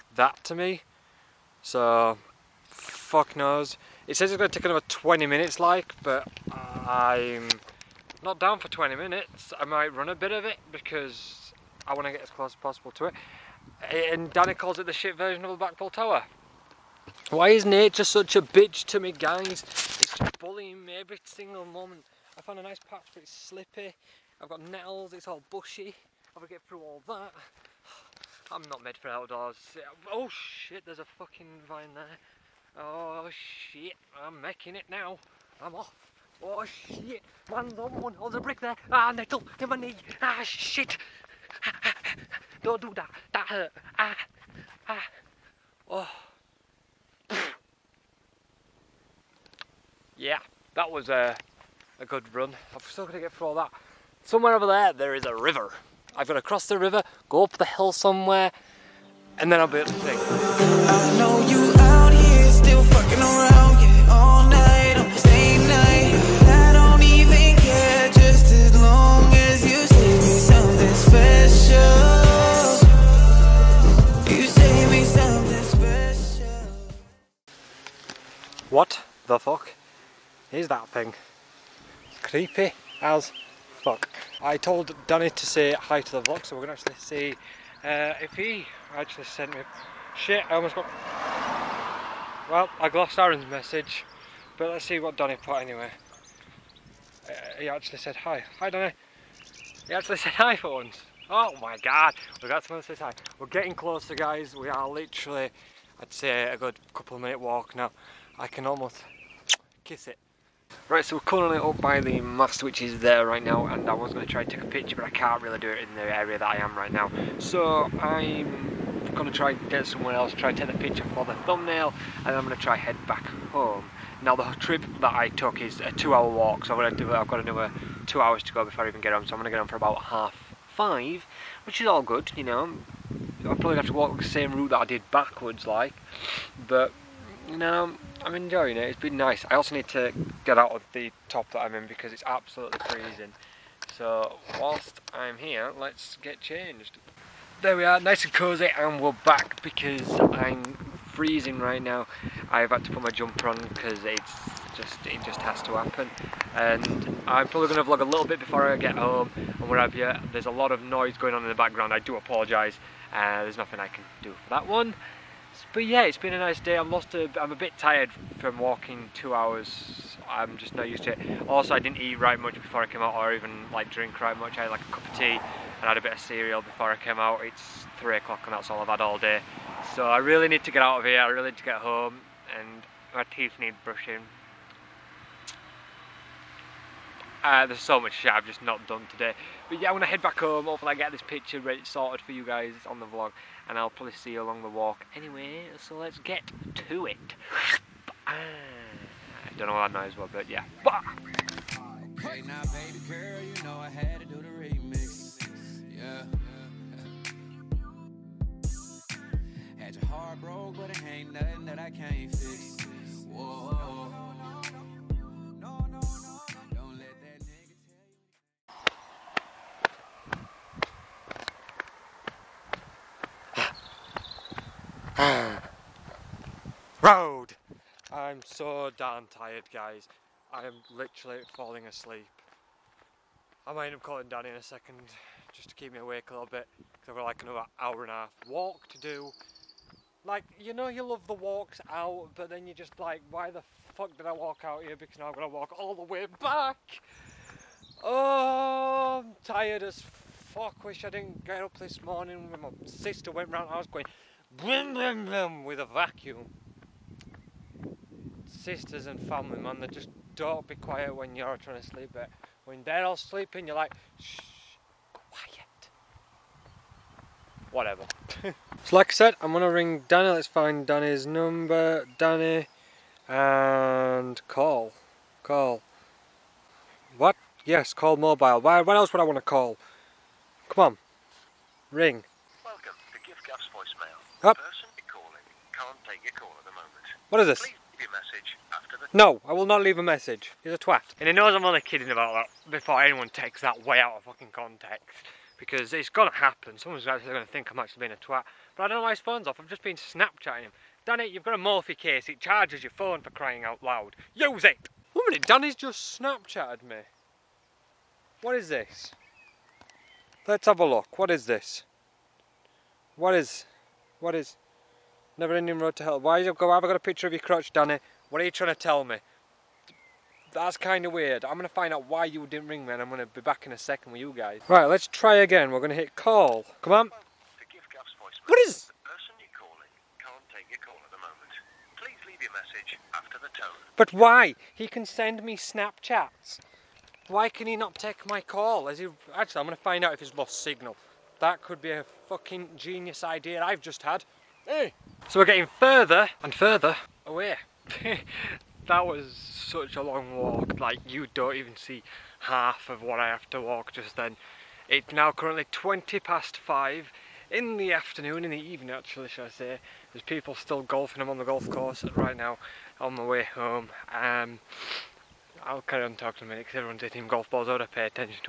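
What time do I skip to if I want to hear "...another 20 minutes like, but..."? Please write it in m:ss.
0:04.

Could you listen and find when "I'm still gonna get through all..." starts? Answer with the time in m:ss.
0:52.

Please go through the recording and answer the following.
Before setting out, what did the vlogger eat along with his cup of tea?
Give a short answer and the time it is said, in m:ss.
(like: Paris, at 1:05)
cereal, at 2:56.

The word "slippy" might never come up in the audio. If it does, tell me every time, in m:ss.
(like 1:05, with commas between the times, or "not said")
0:23.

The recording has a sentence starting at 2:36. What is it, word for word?
And I'm probably going to vlog a little bit before I get home and whatever.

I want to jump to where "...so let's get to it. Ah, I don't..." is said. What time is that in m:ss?
3:15.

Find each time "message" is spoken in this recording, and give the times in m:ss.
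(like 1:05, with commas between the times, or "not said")
1:33, 4:50.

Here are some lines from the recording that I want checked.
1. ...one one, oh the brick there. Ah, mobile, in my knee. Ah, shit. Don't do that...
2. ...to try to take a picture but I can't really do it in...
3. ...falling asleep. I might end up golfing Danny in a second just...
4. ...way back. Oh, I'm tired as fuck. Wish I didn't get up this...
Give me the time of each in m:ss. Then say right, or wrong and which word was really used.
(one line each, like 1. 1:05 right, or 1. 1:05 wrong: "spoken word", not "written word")
1. 0:37 wrong: "nettle", not "mobile"
2. 1:54 right
3. 3:51 wrong: "calling", not "golfing"
4. 4:06 right.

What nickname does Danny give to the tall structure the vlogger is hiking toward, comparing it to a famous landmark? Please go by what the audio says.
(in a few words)
the shit version of the Blackpool Tower.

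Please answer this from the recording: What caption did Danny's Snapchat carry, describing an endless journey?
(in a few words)
Never ending road to hell.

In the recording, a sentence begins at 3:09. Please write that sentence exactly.
But yeah, I'm gonna head back home.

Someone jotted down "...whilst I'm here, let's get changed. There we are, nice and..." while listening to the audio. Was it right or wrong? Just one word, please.
right.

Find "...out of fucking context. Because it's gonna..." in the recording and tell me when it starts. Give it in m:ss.
4:53.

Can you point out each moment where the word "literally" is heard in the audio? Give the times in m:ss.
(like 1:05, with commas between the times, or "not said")
1:44, 3:50.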